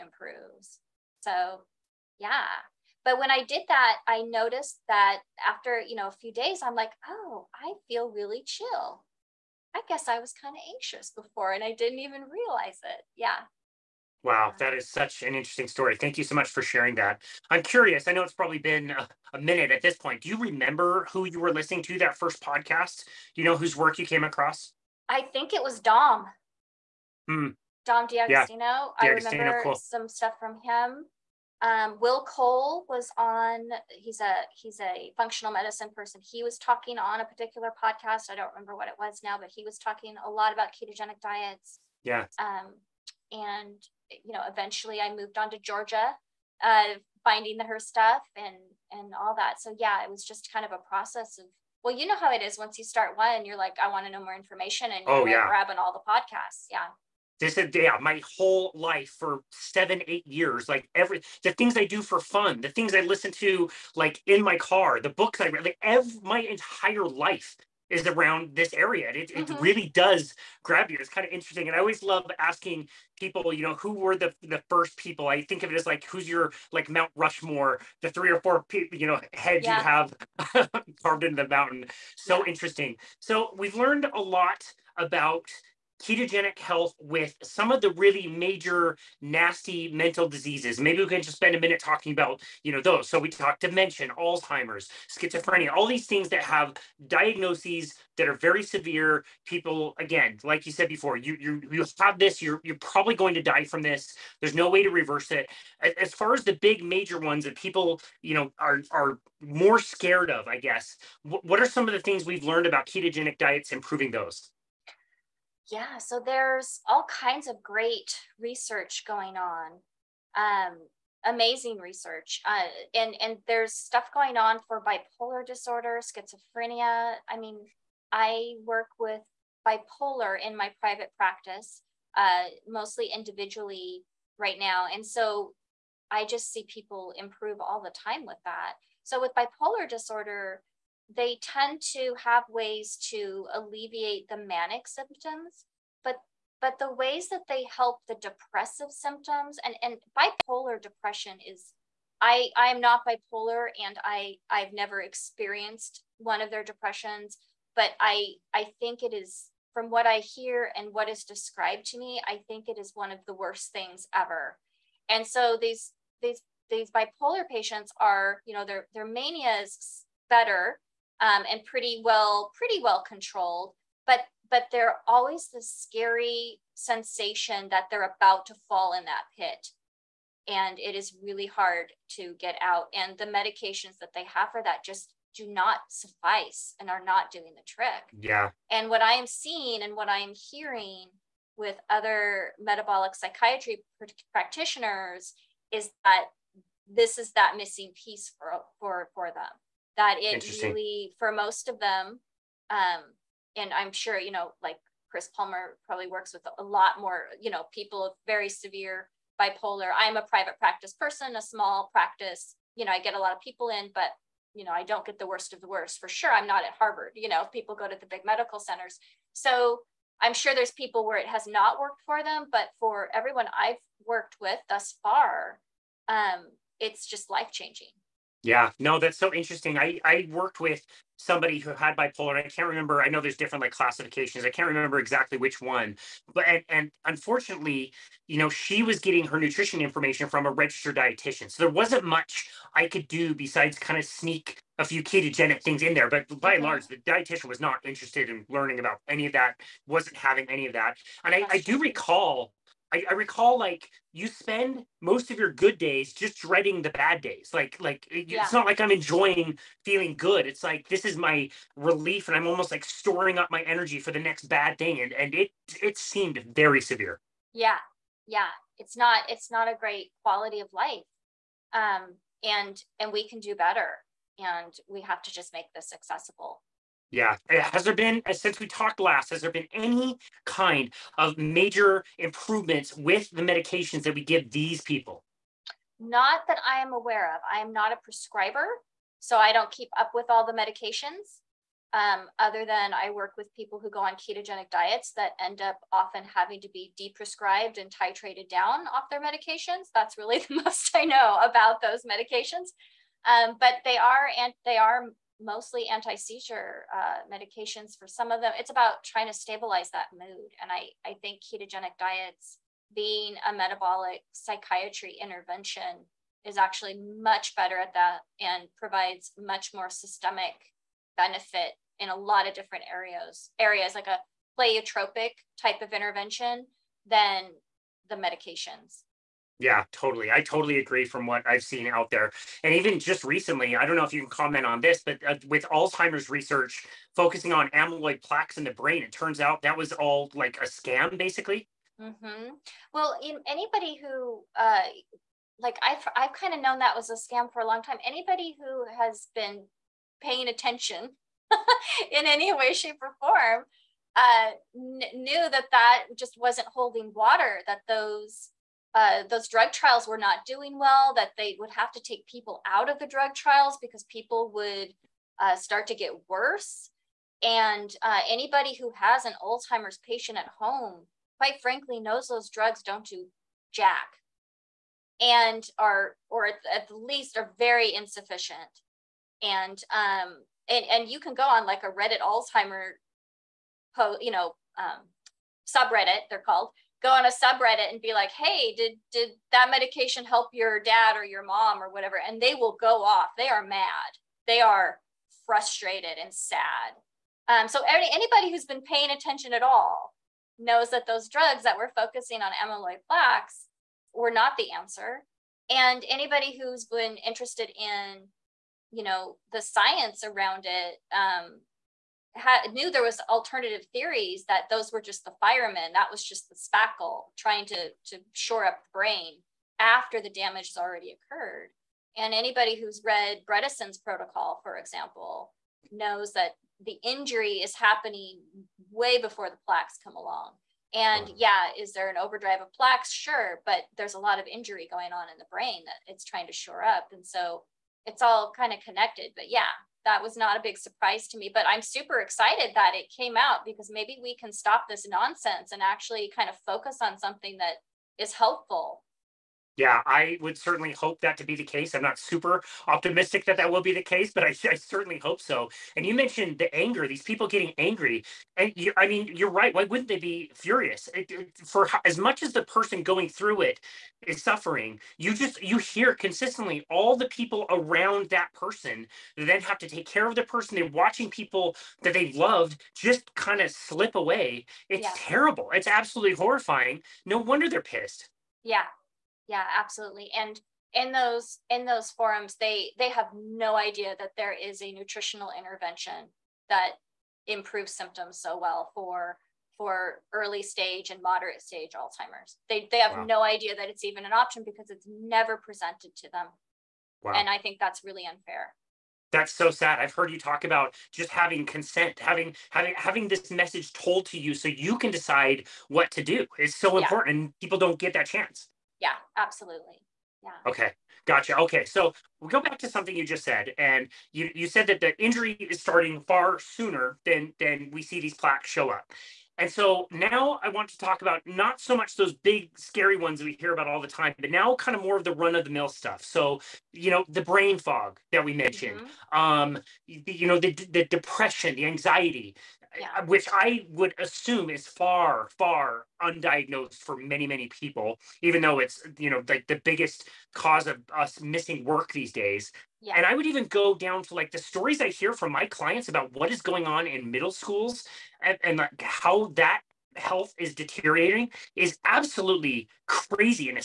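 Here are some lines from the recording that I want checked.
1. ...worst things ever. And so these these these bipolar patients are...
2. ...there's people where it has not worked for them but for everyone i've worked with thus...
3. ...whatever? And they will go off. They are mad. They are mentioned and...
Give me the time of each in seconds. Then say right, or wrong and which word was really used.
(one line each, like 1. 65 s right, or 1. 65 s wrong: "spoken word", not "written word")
1. 163 s right
2. 220 s right
3. 391 s wrong: "frustrated", not "mentioned".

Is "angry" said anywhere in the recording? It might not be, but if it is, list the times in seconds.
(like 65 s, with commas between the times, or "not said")
457 s.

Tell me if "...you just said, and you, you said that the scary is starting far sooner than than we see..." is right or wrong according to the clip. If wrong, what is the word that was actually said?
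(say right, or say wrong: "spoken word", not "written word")
wrong: "injury", not "scary".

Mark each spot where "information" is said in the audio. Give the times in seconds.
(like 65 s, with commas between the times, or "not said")
54 s, 239 s.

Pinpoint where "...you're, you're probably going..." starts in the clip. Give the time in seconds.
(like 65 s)
102 s.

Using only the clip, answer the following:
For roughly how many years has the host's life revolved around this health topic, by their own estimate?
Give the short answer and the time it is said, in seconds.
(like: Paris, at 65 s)
7 or 8 years, at 59 s.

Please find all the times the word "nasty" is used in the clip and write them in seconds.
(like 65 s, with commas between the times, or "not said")
89 s.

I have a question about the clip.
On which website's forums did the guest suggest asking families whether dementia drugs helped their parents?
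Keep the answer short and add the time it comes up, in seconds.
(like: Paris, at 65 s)
Reddit, at 381 s.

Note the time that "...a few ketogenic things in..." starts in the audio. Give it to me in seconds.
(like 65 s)
244 s.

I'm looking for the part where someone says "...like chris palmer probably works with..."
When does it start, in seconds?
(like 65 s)
204 s.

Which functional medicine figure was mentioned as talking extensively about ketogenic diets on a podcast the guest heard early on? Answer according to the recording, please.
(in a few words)
Will Cole.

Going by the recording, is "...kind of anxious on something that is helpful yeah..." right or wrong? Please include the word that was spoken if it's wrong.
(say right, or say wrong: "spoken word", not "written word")
wrong: "focus", not "anxious".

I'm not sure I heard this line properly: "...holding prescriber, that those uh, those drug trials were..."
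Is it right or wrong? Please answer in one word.
wrong.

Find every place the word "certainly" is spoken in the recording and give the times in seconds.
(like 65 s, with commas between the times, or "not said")
450 s, 454 s.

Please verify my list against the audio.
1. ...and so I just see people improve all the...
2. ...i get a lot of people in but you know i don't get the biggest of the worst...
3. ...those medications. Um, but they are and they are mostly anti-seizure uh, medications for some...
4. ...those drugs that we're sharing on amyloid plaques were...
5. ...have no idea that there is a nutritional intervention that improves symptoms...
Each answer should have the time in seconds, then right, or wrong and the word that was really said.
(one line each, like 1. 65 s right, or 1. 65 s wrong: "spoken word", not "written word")
1. 134 s right
2. 212 s wrong: "worst", not "biggest"
3. 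301 s right
4. 401 s wrong: "focusing", not "sharing"
5. 483 s right.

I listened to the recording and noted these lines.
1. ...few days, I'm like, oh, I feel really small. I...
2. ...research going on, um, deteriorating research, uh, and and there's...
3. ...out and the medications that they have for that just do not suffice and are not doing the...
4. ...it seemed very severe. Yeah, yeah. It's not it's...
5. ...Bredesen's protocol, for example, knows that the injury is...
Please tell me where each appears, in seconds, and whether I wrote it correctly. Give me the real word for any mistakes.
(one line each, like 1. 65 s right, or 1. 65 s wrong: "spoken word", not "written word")
1. 6 s wrong: "chill", not "small"
2. 118 s wrong: "amazing", not "deteriorating"
3. 182 s right
4. 265 s right
5. 423 s right.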